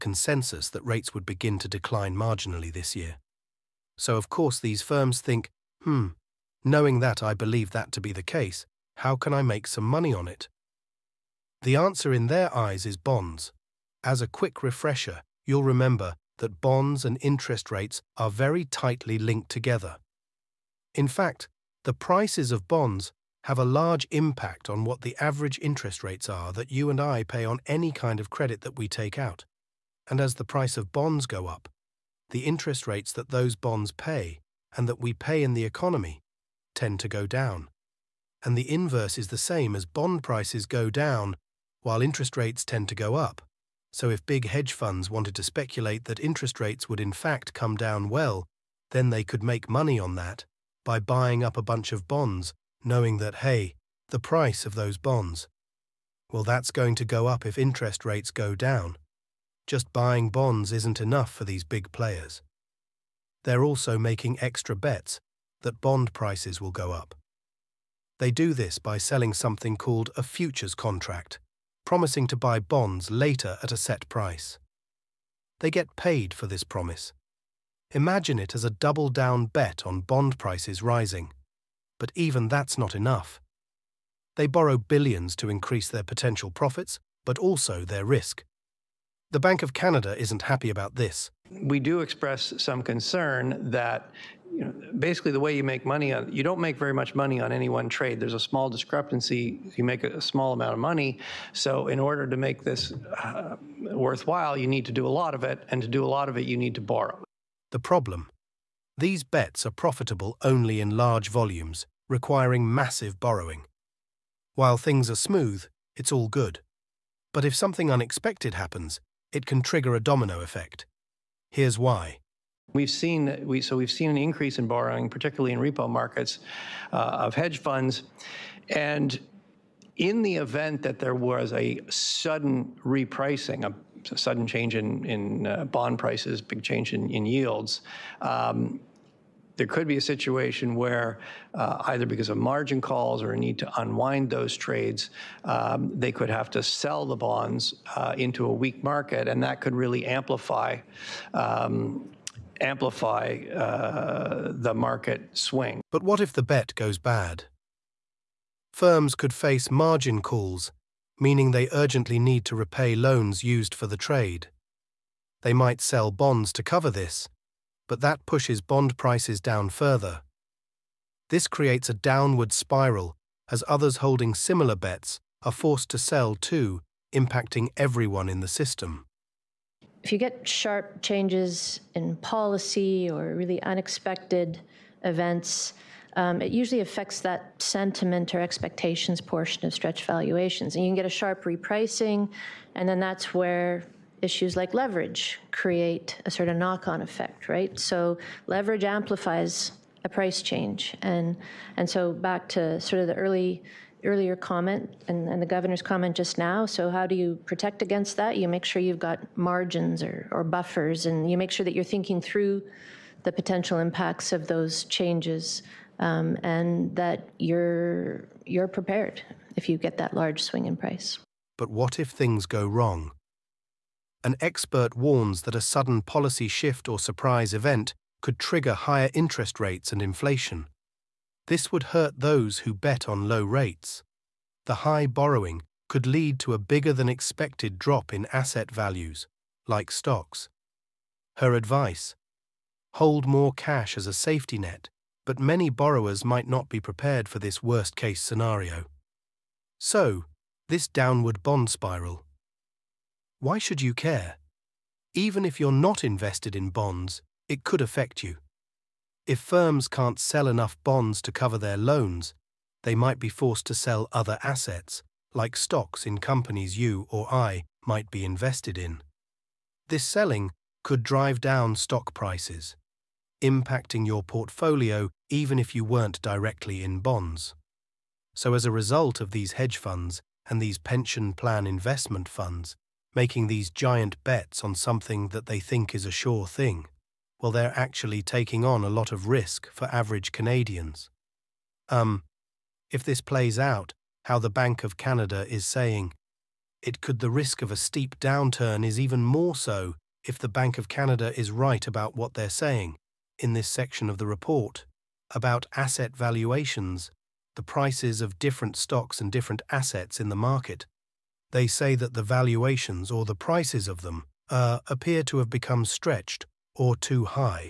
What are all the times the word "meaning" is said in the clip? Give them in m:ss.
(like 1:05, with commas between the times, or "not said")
2:41.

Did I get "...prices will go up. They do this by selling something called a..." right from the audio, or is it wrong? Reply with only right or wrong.
right.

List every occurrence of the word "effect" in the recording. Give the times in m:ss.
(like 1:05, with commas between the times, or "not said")
2:00, 3:17.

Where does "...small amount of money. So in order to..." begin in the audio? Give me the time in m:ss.
1:40.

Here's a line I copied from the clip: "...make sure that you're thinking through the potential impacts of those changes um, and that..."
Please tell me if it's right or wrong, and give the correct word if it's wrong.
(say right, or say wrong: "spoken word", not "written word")
right.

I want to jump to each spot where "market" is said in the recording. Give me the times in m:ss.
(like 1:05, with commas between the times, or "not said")
2:05, 2:28, 2:34, 5:10.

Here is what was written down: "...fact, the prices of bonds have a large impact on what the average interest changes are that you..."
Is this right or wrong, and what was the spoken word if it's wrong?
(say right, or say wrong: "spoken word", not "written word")
wrong: "rates", not "changes".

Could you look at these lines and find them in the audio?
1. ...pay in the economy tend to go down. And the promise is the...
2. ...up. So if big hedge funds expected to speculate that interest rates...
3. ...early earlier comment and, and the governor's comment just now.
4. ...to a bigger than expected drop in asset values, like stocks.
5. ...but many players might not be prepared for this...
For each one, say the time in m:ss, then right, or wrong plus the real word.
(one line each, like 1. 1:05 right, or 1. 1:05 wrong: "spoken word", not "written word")
1. 0:35 wrong: "inverse", not "promise"
2. 0:43 wrong: "wanted", not "expected"
3. 3:23 right
4. 3:56 right
5. 4:05 wrong: "borrowers", not "players".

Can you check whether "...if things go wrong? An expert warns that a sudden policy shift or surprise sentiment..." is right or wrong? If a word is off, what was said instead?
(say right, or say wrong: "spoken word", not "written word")
wrong: "event", not "sentiment".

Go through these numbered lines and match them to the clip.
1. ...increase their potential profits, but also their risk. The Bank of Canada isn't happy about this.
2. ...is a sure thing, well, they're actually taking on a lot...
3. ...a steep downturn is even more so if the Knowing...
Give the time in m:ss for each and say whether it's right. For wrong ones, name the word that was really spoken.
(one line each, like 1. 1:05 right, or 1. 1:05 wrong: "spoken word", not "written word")
1. 1:25 right
2. 4:45 right
3. 4:57 wrong: "Bank", not "Knowing".